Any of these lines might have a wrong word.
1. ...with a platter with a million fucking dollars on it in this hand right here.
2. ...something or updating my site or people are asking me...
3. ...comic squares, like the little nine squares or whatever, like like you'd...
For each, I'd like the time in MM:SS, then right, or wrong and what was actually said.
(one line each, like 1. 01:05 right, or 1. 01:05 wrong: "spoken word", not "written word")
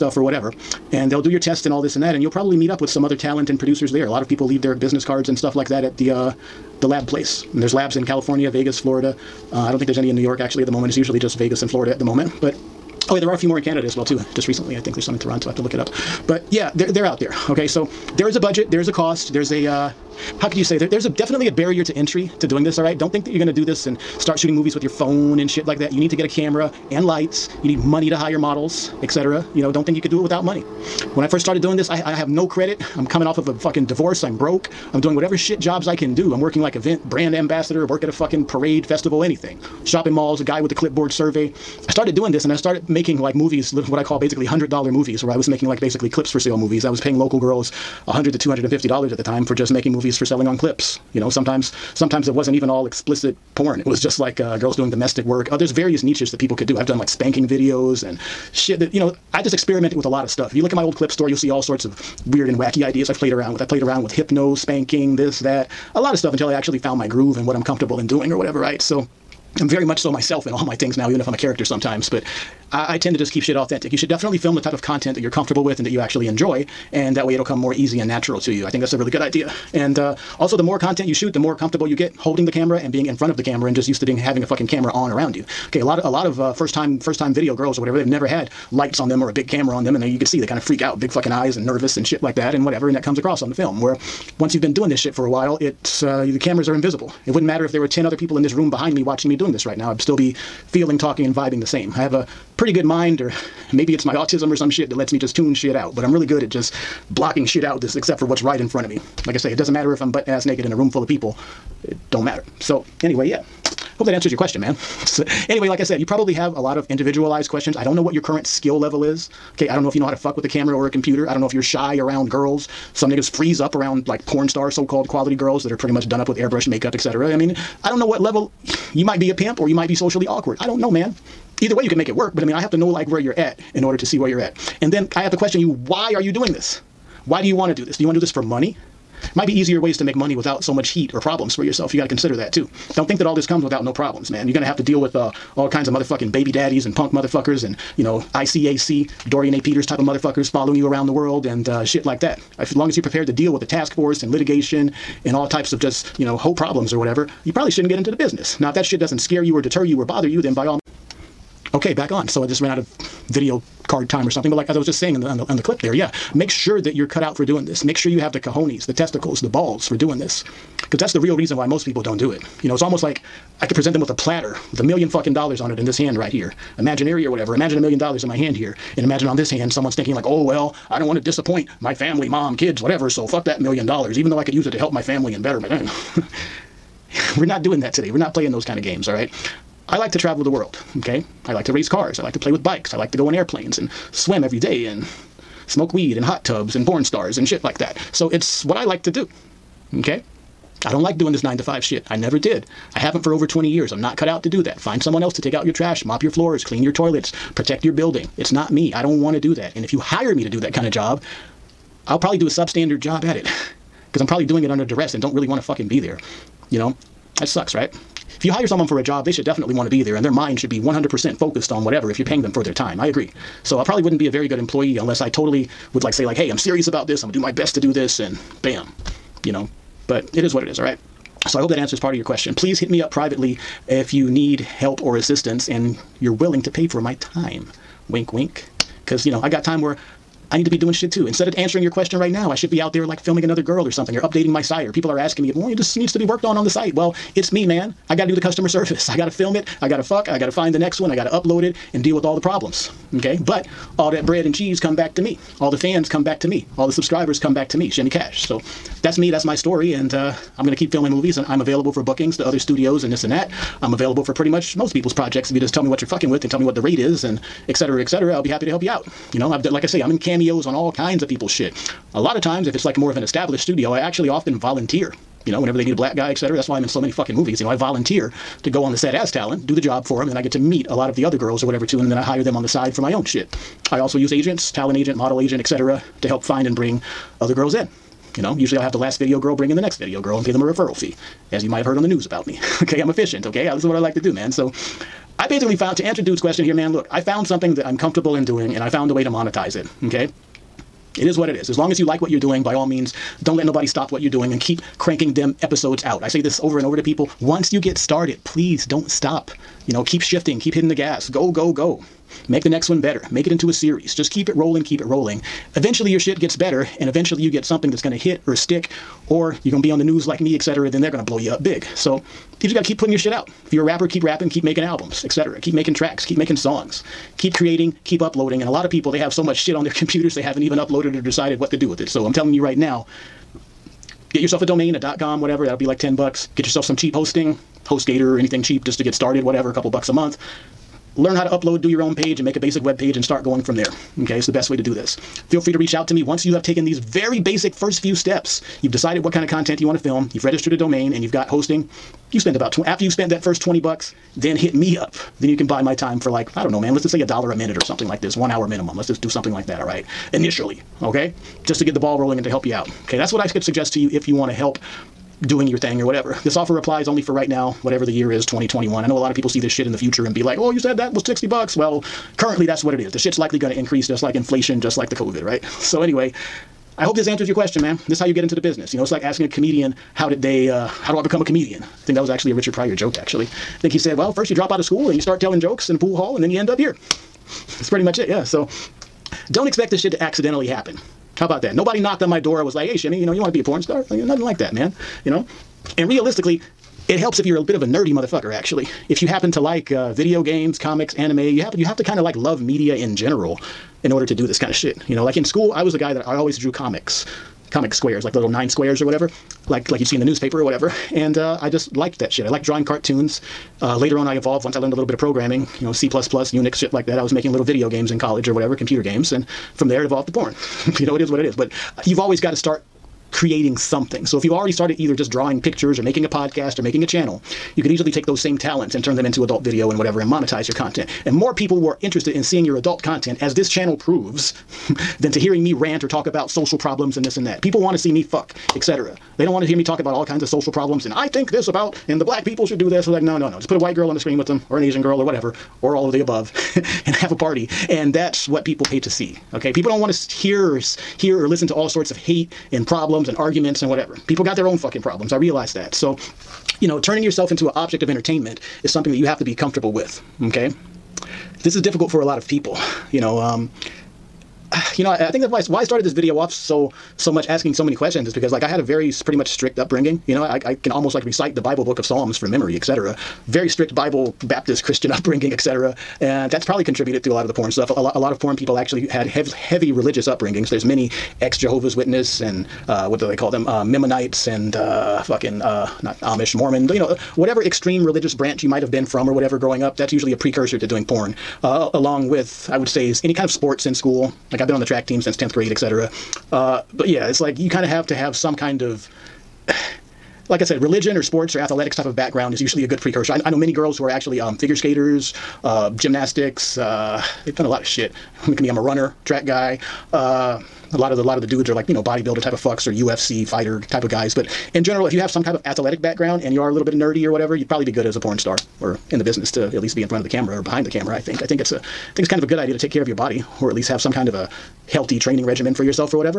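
1. 02:54 right
2. 04:03 right
3. 06:47 right.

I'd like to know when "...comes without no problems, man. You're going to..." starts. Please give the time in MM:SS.
02:23.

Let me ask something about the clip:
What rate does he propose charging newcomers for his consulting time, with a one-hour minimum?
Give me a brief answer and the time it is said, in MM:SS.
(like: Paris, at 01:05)
A dollar a minute, at 05:57.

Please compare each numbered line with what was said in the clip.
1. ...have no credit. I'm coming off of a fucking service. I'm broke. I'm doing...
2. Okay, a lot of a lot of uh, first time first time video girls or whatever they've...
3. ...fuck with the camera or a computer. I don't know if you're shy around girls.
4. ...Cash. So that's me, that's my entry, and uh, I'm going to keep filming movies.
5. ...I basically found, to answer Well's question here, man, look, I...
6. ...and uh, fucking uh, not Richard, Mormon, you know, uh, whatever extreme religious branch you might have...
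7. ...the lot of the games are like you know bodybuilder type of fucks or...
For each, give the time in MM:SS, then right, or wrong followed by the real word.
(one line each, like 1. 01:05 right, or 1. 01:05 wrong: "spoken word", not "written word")
1. 00:32 wrong: "divorce", not "service"
2. 01:25 right
3. 02:00 right
4. 04:18 wrong: "story", not "entry"
5. 04:55 wrong: "Dude", not "Well"
6. 08:04 wrong: "Amish", not "Richard"
7. 08:31 wrong: "dudes", not "games".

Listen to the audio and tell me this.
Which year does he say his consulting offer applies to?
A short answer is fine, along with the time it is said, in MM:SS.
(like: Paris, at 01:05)
2021, at 06:08.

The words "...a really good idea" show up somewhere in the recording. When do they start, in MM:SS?
01:18.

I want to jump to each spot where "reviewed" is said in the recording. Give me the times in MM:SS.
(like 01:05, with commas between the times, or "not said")
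not said.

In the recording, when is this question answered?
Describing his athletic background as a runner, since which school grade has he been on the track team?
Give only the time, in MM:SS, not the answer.
08:15.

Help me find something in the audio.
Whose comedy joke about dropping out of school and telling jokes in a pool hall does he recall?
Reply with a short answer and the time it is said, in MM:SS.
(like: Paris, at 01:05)
Richard Pryor, at 06:22.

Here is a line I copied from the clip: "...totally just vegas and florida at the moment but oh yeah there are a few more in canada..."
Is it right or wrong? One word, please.
wrong.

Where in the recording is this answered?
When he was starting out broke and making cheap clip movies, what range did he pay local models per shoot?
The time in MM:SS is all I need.
00:48.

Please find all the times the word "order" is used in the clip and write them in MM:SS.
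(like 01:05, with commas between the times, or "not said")
02:13, 06:44.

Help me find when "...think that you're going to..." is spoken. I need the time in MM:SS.
00:23.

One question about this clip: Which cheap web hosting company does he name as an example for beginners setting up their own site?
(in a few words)
HostGator.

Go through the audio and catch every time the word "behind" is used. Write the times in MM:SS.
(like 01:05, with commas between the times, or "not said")
01:38, 08:40.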